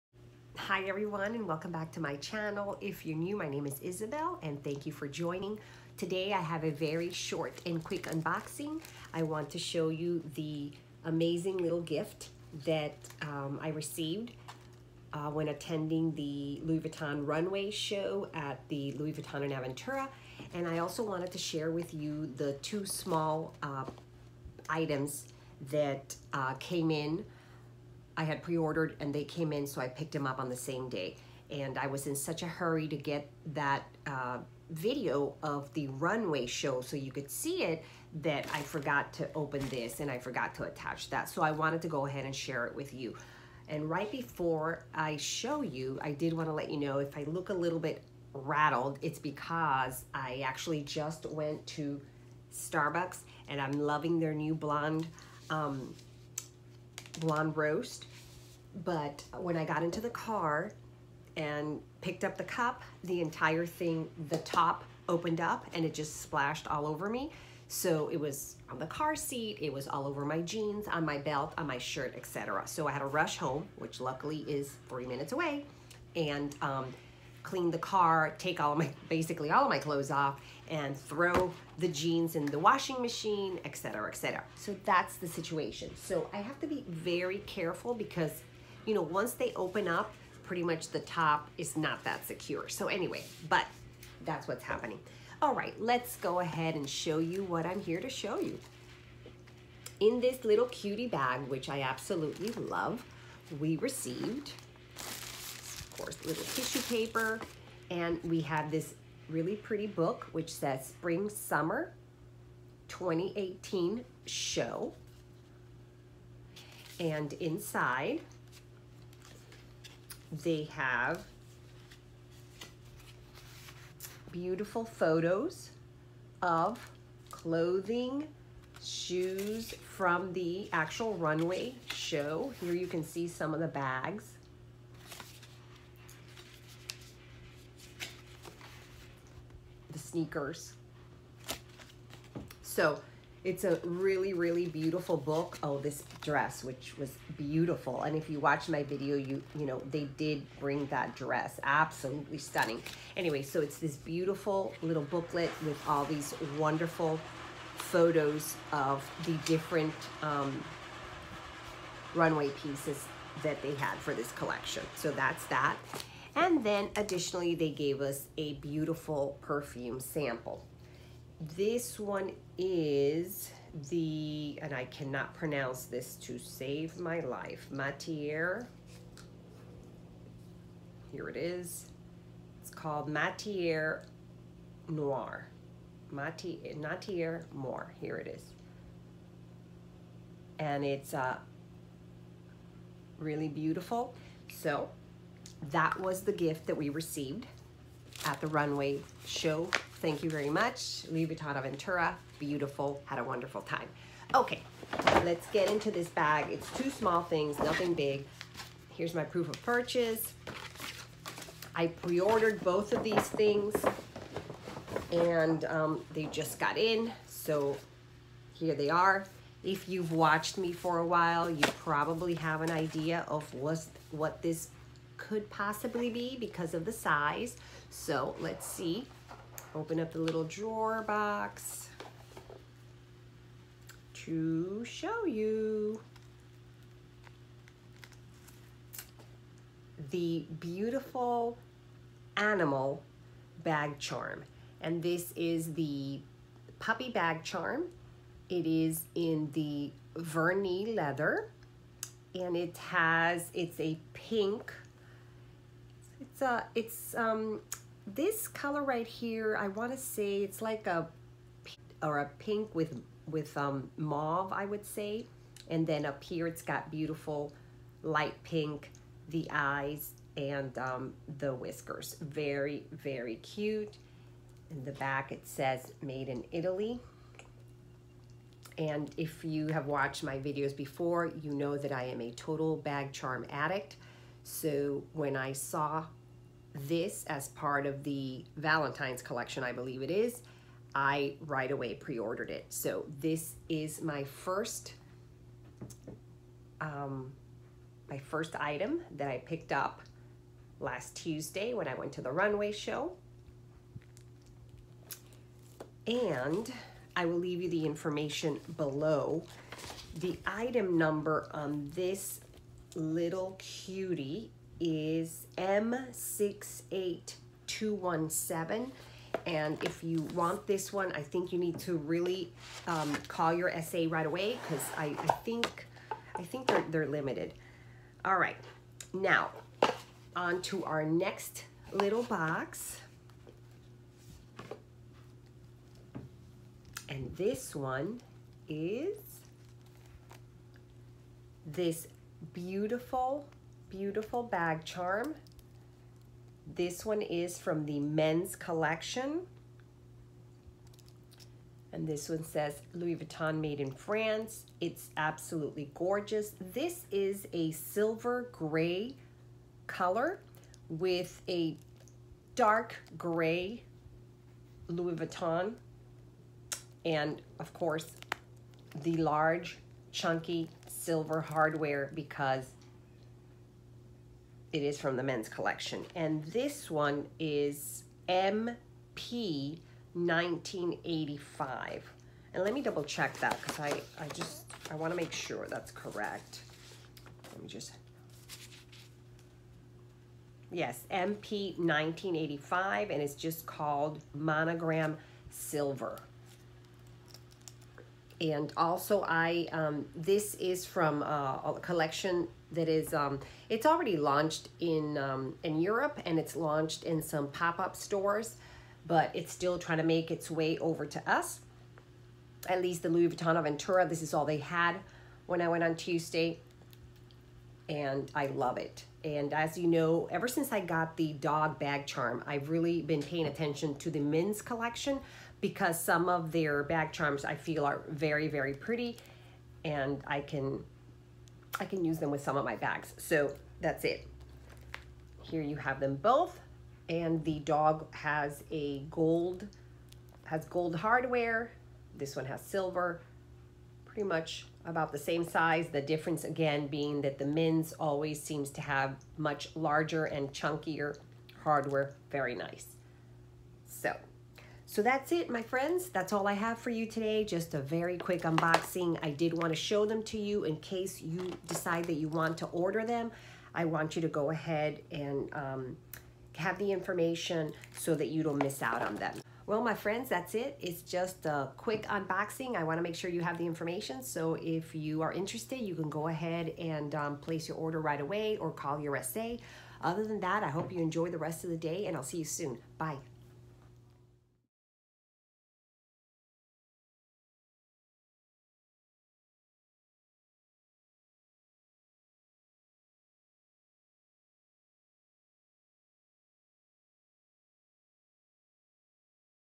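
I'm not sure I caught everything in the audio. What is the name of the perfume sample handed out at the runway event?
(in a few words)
Matiere Noir.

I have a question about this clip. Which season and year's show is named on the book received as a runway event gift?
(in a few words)
Spring Summer 2018.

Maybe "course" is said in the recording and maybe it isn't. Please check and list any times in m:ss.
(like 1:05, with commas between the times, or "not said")
1:45, 6:07.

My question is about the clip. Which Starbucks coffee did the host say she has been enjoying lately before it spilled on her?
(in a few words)
blonde roast.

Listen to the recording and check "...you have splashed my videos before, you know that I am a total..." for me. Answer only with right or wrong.
wrong.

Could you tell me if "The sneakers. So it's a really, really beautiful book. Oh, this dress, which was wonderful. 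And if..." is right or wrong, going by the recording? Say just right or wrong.
wrong.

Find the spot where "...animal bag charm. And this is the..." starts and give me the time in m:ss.
4:02.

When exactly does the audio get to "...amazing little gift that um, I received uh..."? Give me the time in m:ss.
0:11.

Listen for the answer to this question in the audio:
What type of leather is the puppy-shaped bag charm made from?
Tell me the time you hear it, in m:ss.
4:10.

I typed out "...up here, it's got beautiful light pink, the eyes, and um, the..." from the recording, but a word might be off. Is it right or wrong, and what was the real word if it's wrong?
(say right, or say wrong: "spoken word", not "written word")
right.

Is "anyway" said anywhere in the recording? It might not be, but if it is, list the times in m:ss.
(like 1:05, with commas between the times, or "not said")
1:32, 2:33.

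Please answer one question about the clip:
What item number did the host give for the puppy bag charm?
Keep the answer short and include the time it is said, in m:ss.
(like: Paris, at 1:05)
M68217, at 5:15.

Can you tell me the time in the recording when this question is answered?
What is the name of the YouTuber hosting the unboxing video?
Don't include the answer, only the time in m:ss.
0:03.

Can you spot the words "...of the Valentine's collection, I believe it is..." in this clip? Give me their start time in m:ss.
4:47.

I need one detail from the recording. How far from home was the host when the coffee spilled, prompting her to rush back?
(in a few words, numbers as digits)
three minutes.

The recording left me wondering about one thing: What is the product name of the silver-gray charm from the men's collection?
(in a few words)
Monogram Silver.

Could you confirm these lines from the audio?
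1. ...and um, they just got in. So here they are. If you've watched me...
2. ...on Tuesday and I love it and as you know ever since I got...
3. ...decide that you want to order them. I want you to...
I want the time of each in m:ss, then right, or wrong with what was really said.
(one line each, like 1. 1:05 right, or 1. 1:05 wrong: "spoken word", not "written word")
1. 3:35 right
2. 6:55 right
3. 7:41 right.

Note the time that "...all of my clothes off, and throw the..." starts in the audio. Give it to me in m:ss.
1:19.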